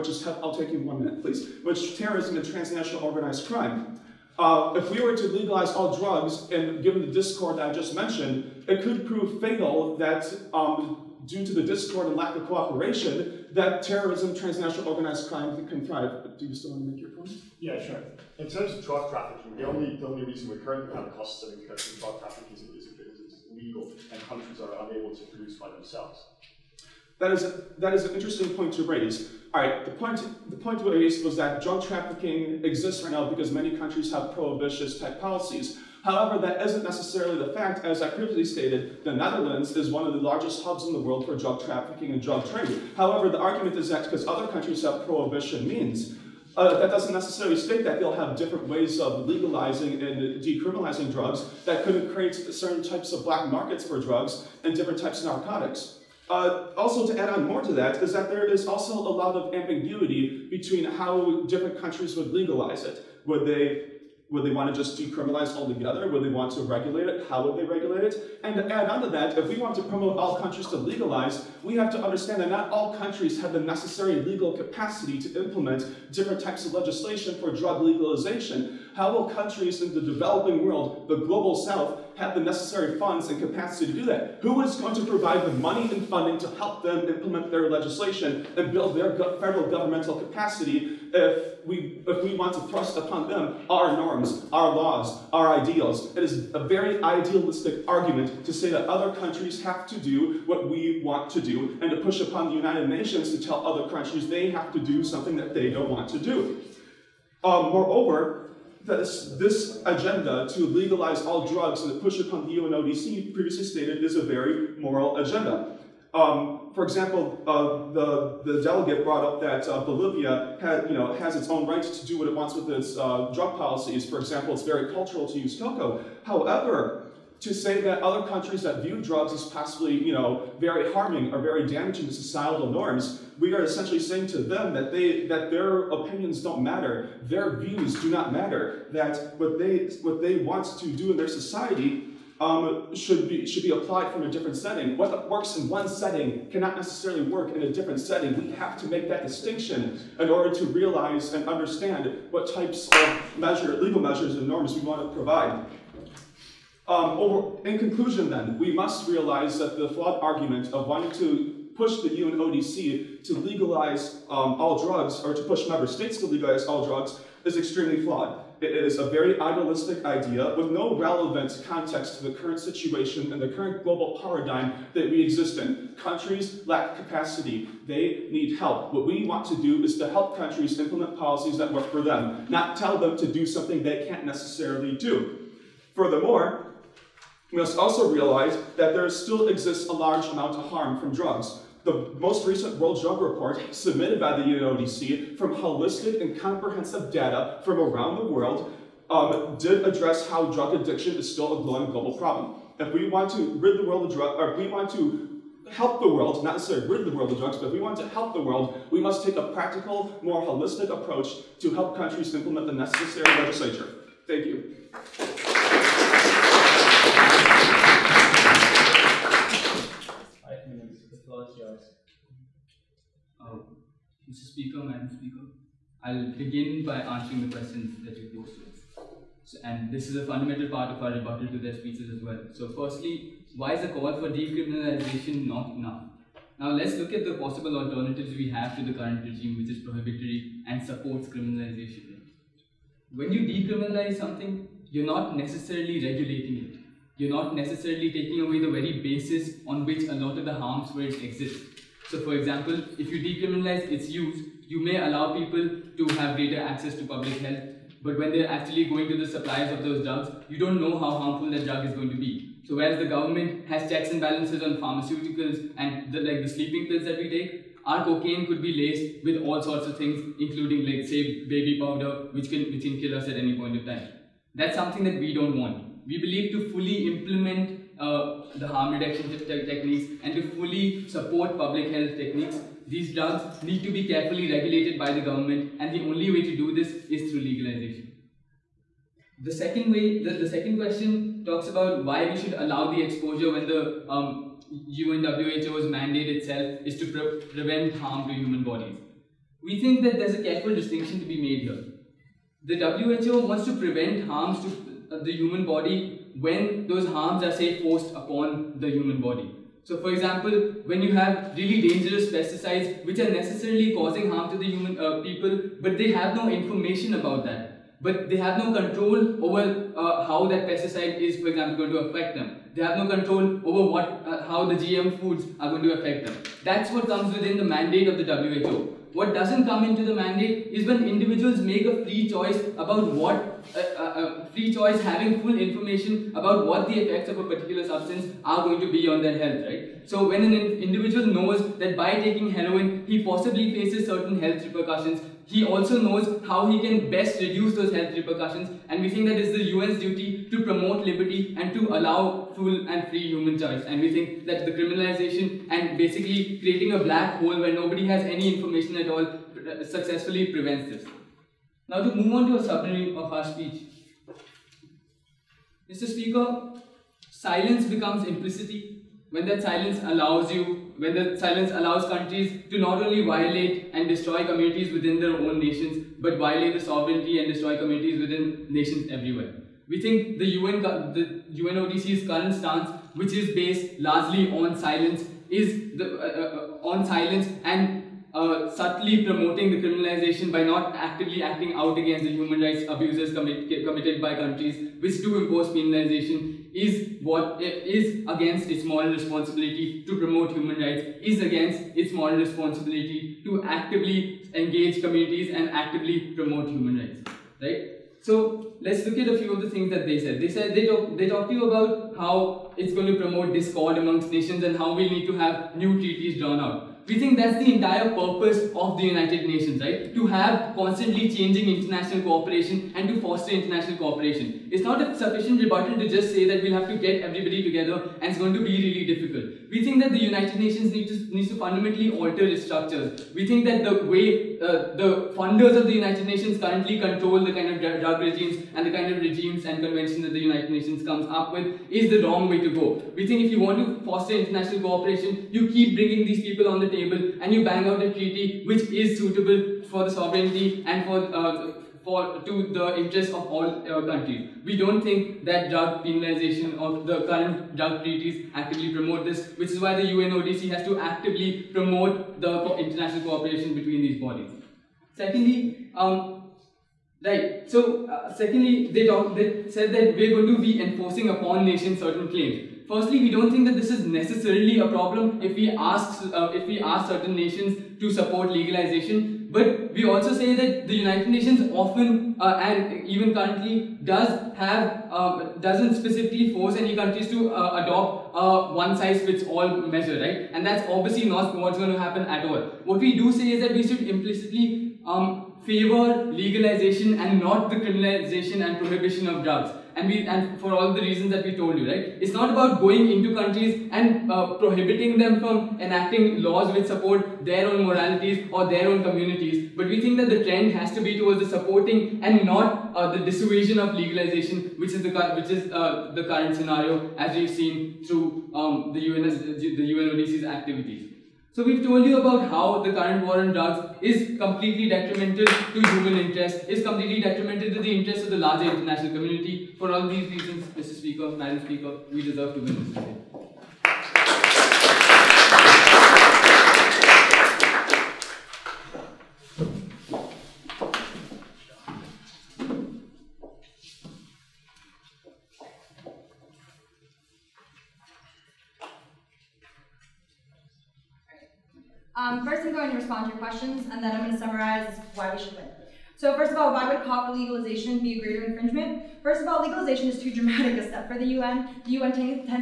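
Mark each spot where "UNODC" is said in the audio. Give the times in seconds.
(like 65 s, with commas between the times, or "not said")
112 s, 162 s, 194 s, 381 s, 460 s, 519 s.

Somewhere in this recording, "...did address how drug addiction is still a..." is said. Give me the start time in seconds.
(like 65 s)
199 s.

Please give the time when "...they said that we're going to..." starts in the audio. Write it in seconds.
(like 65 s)
469 s.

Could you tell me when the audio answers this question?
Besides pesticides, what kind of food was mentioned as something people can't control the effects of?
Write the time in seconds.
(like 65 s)
324 s.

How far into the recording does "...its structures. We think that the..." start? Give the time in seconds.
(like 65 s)
432 s.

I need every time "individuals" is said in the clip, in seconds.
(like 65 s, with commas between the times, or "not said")
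331 s, 340 s.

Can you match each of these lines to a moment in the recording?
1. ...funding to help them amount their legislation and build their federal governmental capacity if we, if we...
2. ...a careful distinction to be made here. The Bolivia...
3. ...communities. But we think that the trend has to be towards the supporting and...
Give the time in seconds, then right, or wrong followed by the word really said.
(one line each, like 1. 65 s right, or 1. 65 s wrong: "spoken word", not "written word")
1. 86 s wrong: "implement", not "amount"
2. 300 s wrong: "WHO", not "Bolivia"
3. 509 s right.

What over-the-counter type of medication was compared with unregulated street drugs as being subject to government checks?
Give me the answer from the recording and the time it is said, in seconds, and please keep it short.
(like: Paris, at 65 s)
Sleeping pills, at 266 s.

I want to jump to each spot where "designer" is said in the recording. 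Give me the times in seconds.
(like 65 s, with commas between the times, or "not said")
not said.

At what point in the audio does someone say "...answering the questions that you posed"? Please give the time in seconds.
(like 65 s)
226 s.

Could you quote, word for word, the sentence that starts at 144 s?
What works in one setting cannot necessarily work in a different setting.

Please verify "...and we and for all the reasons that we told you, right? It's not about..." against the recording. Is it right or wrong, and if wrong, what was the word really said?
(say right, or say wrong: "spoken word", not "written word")
right.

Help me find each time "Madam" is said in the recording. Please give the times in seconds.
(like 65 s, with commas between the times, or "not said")
224 s, 531 s.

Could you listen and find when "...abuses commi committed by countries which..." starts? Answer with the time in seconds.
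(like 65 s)
392 s.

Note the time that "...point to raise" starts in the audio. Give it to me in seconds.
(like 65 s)
28 s.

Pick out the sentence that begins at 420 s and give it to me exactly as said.
To have constantly changing international cooperation and to foster international cooperation.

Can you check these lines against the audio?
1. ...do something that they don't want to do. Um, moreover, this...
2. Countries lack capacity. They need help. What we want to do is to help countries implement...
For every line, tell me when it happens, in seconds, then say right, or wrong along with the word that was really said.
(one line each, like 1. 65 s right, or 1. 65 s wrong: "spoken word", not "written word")
1. 104 s right
2. 175 s right.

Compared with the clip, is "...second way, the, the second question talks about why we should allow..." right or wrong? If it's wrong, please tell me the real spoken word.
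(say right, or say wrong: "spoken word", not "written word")
right.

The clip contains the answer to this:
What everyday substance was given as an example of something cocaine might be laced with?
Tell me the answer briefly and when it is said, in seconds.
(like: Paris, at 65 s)
Baby powder, at 271 s.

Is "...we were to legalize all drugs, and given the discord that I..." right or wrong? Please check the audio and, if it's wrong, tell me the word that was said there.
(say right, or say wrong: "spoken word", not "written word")
right.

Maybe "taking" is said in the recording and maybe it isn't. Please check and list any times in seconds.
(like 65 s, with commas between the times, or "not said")
248 s, 342 s.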